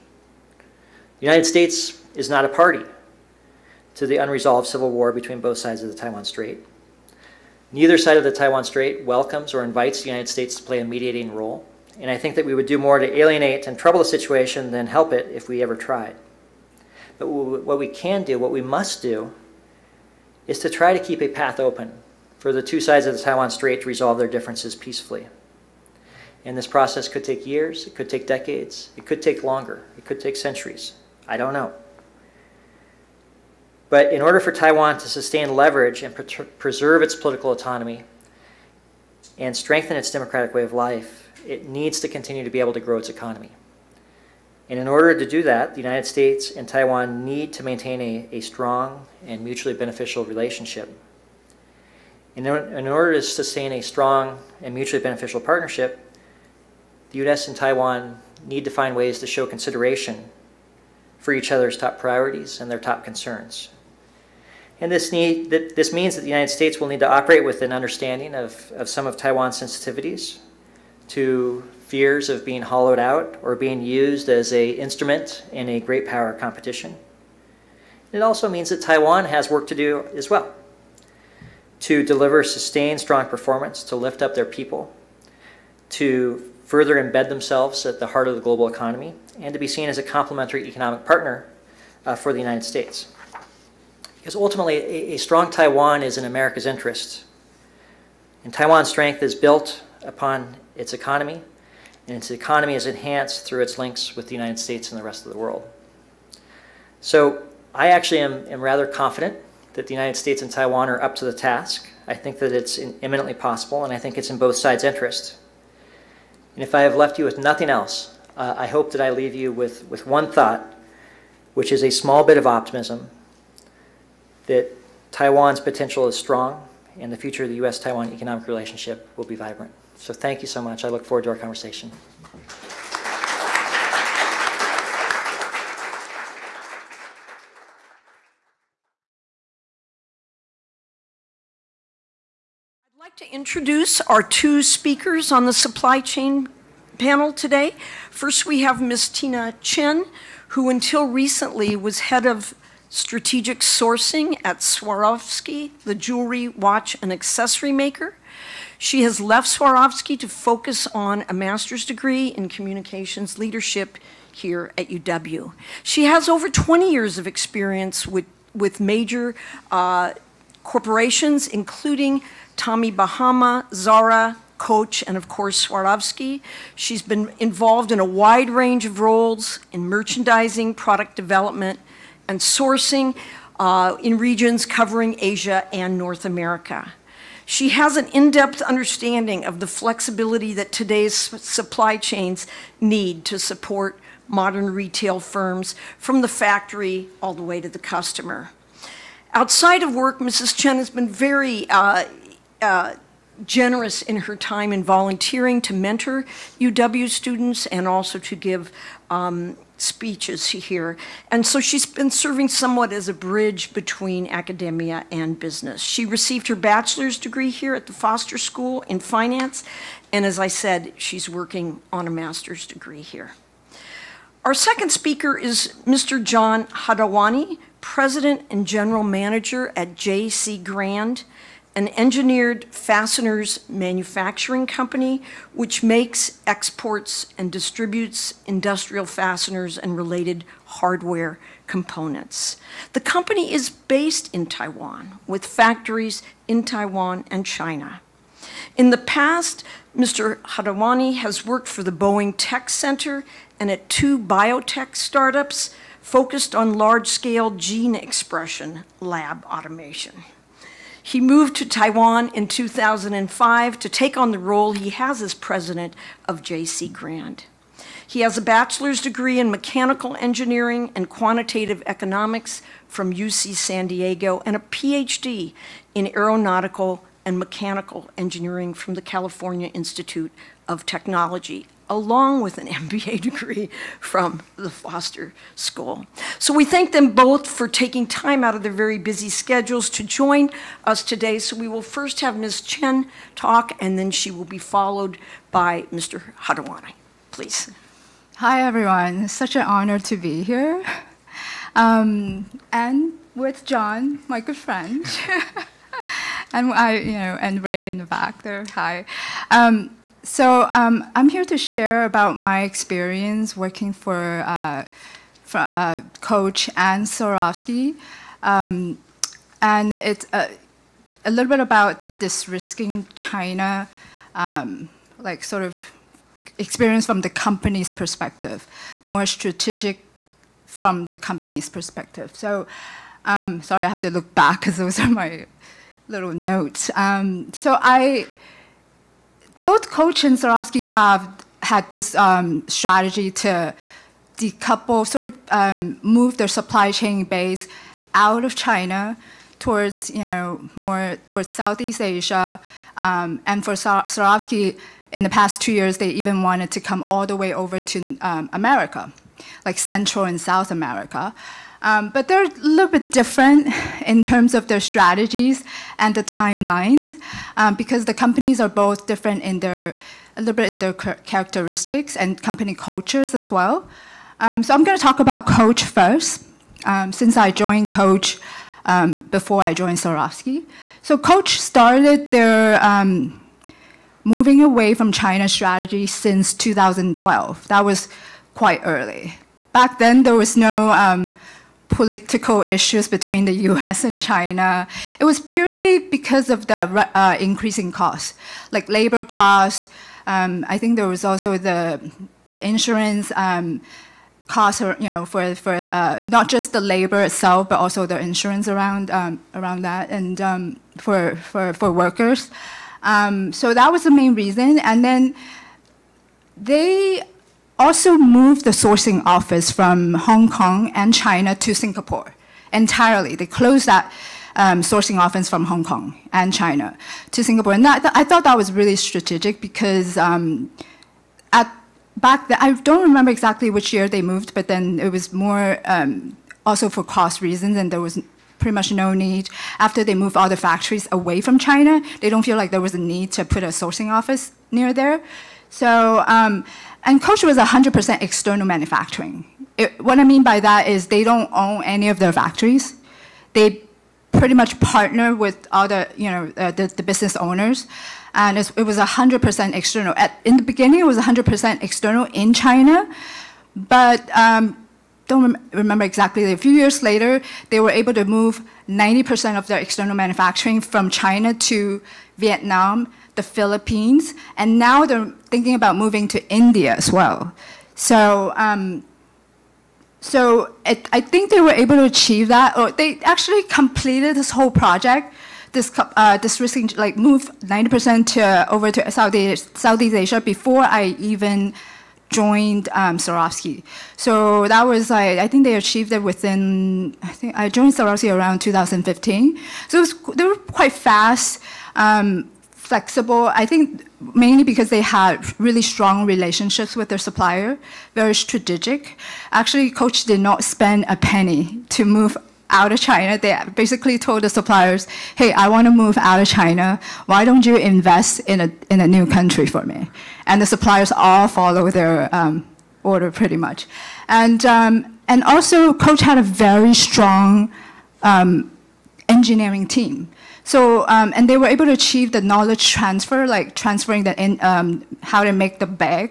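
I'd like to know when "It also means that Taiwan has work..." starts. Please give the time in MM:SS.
01:18.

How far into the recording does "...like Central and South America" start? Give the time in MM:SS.
05:59.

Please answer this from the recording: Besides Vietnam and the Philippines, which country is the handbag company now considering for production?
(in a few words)
India.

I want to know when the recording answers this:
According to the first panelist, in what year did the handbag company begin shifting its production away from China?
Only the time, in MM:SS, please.
06:26.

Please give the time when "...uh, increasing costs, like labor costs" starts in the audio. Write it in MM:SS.
06:37.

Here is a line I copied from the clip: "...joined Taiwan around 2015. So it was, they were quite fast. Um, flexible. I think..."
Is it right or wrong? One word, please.
wrong.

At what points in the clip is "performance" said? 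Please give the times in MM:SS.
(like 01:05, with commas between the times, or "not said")
01:23.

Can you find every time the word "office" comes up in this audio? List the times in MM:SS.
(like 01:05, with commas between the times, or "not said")
06:59, 07:05, 07:24.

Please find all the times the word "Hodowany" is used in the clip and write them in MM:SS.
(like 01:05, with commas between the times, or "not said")
03:46, 04:10, 04:56.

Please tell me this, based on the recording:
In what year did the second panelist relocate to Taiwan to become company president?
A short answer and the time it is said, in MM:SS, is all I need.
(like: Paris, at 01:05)
2005, at 04:22.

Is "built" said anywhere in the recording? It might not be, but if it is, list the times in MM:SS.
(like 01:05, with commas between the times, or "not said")
01:39.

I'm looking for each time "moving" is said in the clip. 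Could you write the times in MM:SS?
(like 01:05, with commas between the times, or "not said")
06:24, 07:55.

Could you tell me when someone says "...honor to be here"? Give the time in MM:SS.
04:59.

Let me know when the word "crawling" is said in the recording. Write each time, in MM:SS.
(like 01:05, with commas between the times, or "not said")
not said.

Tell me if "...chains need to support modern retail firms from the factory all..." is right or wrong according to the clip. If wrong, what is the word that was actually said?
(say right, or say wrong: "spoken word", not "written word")
right.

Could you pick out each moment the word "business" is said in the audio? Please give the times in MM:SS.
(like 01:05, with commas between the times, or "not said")
03:35, 07:37.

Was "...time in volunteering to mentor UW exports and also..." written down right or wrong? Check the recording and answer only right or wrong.
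wrong.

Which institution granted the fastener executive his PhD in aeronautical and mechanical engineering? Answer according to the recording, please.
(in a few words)
California Institute of Technology.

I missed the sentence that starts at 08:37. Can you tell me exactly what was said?
Why don't you invest in a, in a new country for me?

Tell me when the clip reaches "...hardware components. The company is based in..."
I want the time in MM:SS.
04:00.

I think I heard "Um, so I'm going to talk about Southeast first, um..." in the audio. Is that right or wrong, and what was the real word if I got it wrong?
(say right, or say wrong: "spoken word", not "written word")
wrong: "Coach", not "Southeast".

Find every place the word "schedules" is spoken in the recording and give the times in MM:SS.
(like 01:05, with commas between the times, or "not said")
04:49.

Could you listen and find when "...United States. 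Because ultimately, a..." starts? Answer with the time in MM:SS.
01:32.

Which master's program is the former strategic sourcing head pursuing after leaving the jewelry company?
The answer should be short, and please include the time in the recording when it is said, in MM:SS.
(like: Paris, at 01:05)
communications leadership, at 02:42.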